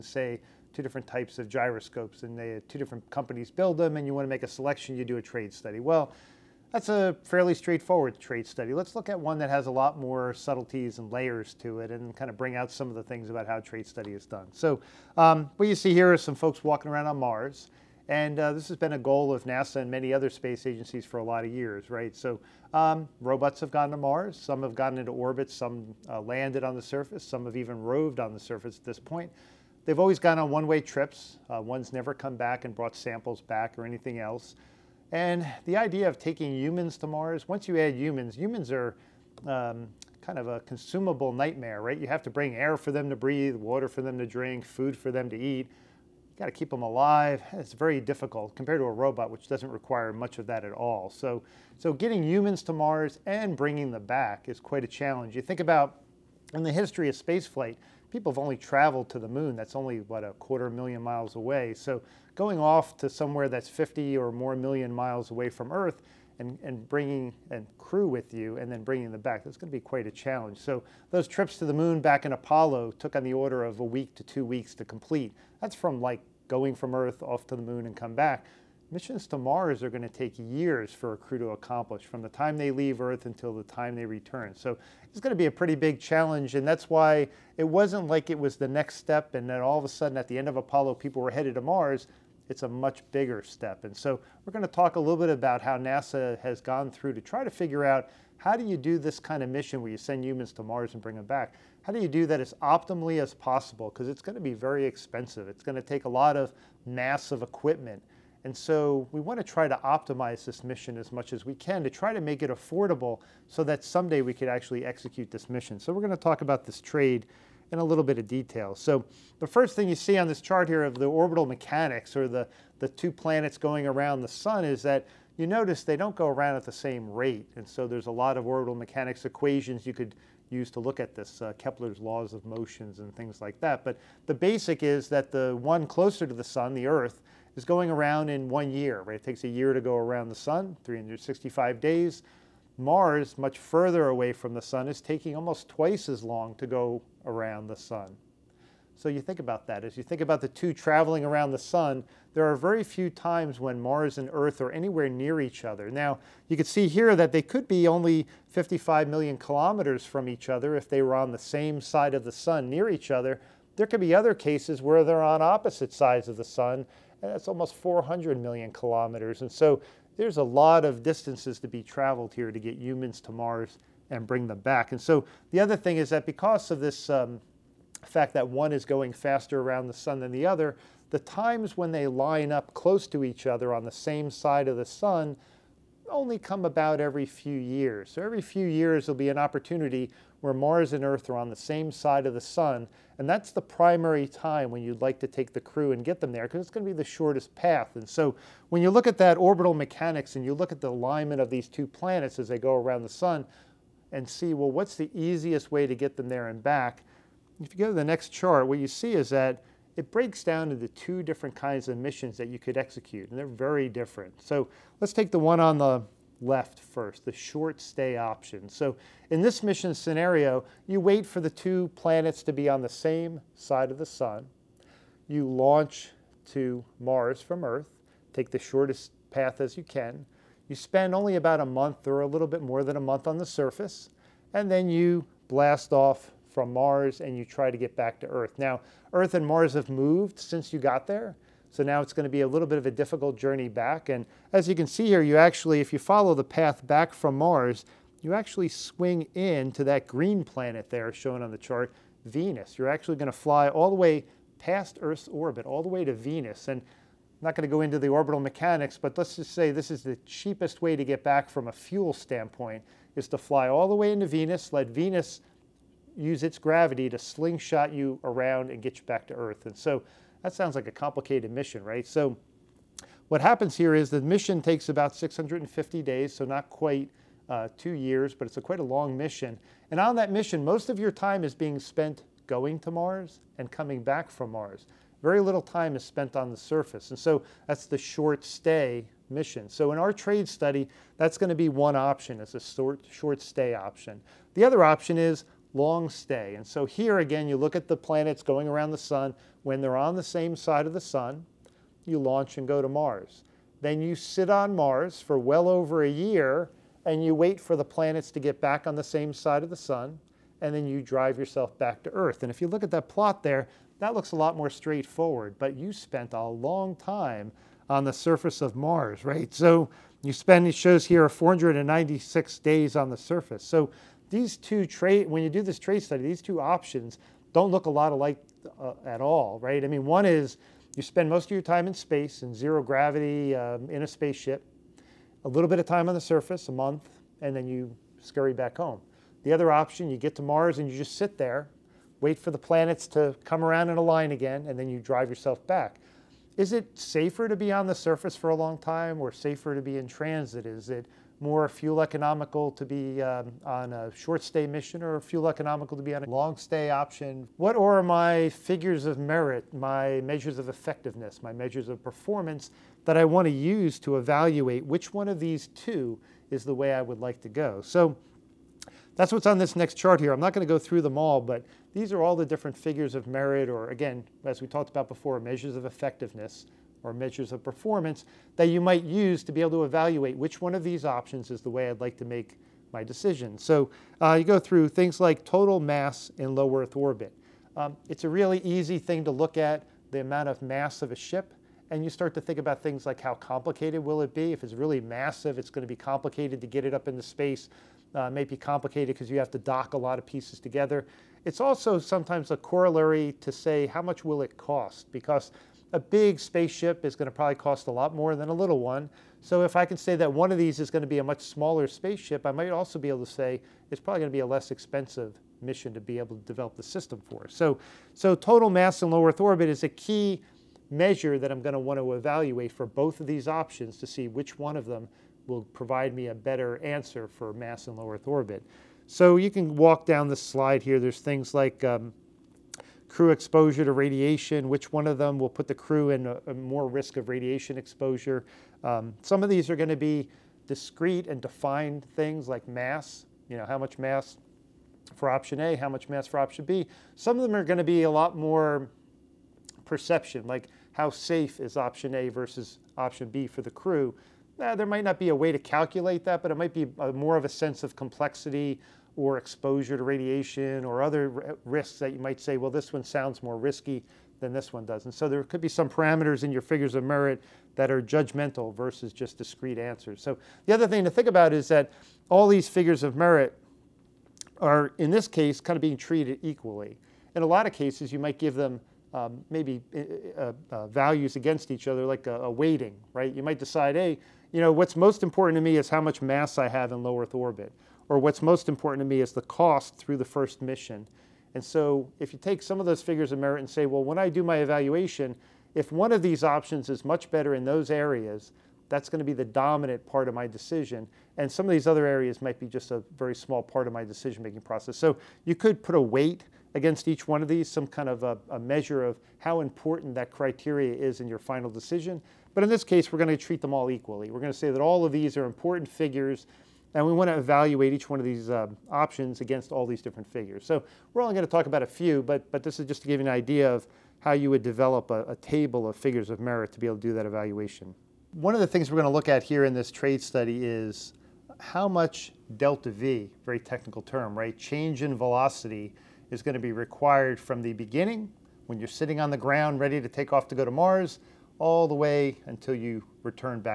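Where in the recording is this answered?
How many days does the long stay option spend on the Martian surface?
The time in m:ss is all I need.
5:21.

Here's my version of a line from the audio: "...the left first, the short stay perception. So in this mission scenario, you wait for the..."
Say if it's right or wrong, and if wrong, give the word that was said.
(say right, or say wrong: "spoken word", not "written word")
wrong: "option", not "perception".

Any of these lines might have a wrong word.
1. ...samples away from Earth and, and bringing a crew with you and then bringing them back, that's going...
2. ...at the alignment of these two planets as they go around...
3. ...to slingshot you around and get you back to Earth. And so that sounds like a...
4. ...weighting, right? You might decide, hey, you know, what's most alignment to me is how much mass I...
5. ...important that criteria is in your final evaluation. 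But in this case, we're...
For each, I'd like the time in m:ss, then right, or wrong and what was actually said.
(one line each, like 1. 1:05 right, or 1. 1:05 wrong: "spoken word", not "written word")
1. 1:04 wrong: "miles", not "samples"
2. 3:20 right
3. 4:27 right
4. 8:02 wrong: "important", not "alignment"
5. 8:29 wrong: "decision", not "evaluation".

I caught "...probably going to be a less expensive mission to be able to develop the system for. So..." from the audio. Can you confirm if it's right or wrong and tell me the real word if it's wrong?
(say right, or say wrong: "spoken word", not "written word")
right.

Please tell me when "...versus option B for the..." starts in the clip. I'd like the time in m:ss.
7:32.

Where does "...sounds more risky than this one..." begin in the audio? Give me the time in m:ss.
7:43.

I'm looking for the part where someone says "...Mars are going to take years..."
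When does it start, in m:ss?
1:19.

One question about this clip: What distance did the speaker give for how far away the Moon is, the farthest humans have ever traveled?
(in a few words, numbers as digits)
a quarter million miles.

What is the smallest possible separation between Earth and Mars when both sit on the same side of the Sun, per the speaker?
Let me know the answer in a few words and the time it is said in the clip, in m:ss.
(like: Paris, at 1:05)
55 million kilometers, at 2:38.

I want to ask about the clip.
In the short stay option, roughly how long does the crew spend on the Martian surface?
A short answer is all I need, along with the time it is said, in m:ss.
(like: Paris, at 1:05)
about a month, at 3:51.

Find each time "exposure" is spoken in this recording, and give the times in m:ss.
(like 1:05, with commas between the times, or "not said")
7:13, 7:17, 7:39.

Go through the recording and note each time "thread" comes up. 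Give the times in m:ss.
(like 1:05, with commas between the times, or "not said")
not said.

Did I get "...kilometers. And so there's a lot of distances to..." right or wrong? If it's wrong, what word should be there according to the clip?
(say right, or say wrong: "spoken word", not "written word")
right.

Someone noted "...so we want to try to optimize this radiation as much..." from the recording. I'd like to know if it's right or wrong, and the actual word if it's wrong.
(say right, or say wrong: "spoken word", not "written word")
wrong: "mission", not "radiation".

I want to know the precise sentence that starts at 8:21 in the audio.
And some of these other areas might be just a very small part of my decision making process.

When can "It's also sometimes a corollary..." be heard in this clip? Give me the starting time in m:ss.
6:41.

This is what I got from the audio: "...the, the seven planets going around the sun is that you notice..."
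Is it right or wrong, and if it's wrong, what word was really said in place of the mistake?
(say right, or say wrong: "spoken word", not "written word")
wrong: "two", not "seven".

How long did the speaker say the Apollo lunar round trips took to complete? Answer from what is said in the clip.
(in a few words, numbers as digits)
a week to two weeks.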